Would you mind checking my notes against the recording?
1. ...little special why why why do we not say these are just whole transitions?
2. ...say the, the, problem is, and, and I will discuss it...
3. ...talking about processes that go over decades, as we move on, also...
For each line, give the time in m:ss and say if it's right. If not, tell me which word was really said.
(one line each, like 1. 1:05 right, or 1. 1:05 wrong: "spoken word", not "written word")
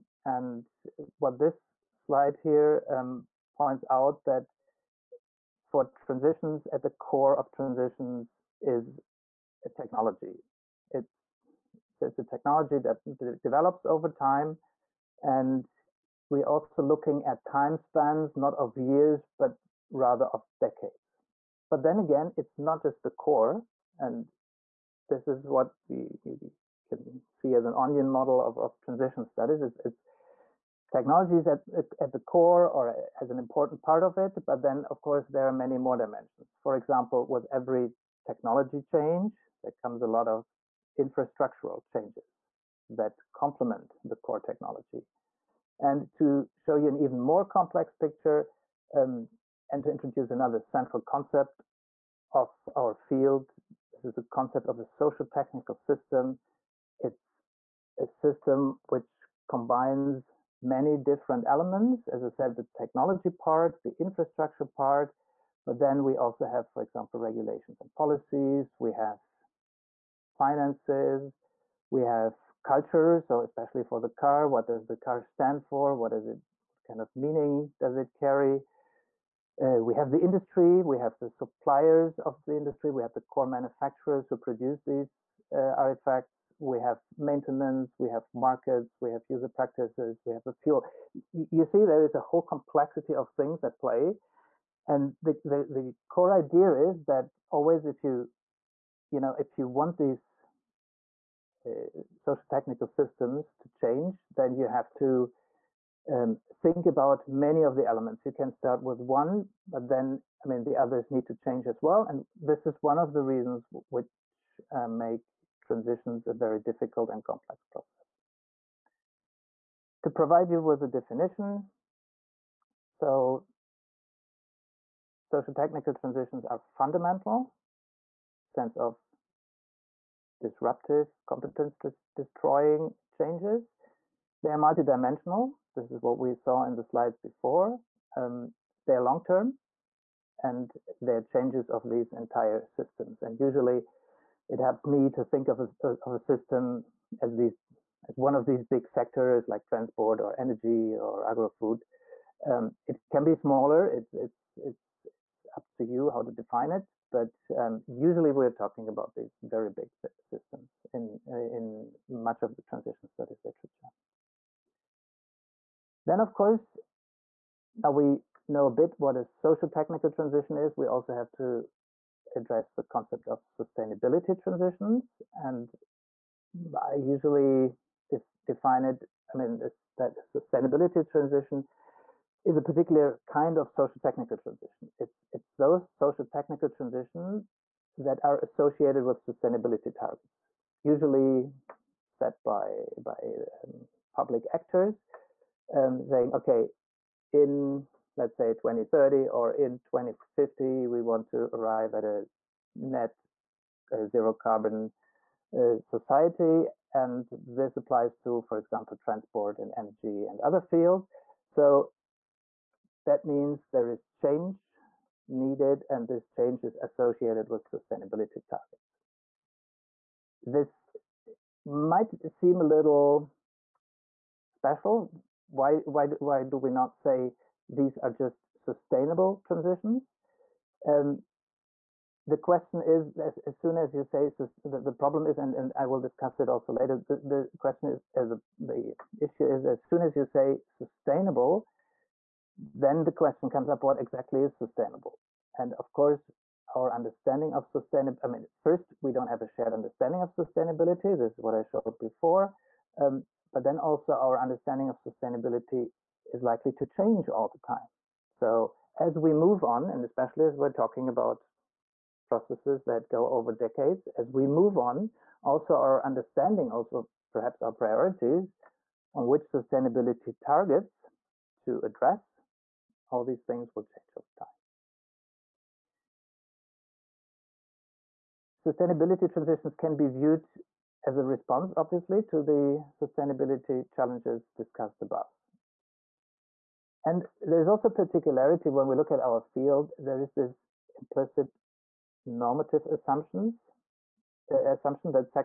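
1. 3:42 wrong: "sustainable", not "whole"
2. 3:54 right
3. 4:20 right.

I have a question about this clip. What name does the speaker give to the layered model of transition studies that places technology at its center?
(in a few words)
onion model.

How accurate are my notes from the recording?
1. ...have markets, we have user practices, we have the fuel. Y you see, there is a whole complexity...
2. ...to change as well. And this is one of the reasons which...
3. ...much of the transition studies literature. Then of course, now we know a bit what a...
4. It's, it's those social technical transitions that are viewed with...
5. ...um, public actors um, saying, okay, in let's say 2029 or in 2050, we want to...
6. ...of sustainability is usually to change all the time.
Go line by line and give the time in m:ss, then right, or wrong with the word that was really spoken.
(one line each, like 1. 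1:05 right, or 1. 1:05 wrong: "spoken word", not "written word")
1. 1:28 right
2. 1:51 right
3. 2:42 right
4. 3:04 wrong: "associated", not "viewed"
5. 3:13 wrong: "2030", not "2029"
6. 4:14 wrong: "likely", not "usually".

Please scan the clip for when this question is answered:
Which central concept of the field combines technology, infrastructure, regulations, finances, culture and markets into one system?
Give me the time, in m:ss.
0:54.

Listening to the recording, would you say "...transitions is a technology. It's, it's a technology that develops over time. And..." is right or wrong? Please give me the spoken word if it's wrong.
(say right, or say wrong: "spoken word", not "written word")
right.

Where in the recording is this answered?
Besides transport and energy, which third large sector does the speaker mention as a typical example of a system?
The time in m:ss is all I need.
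2:31.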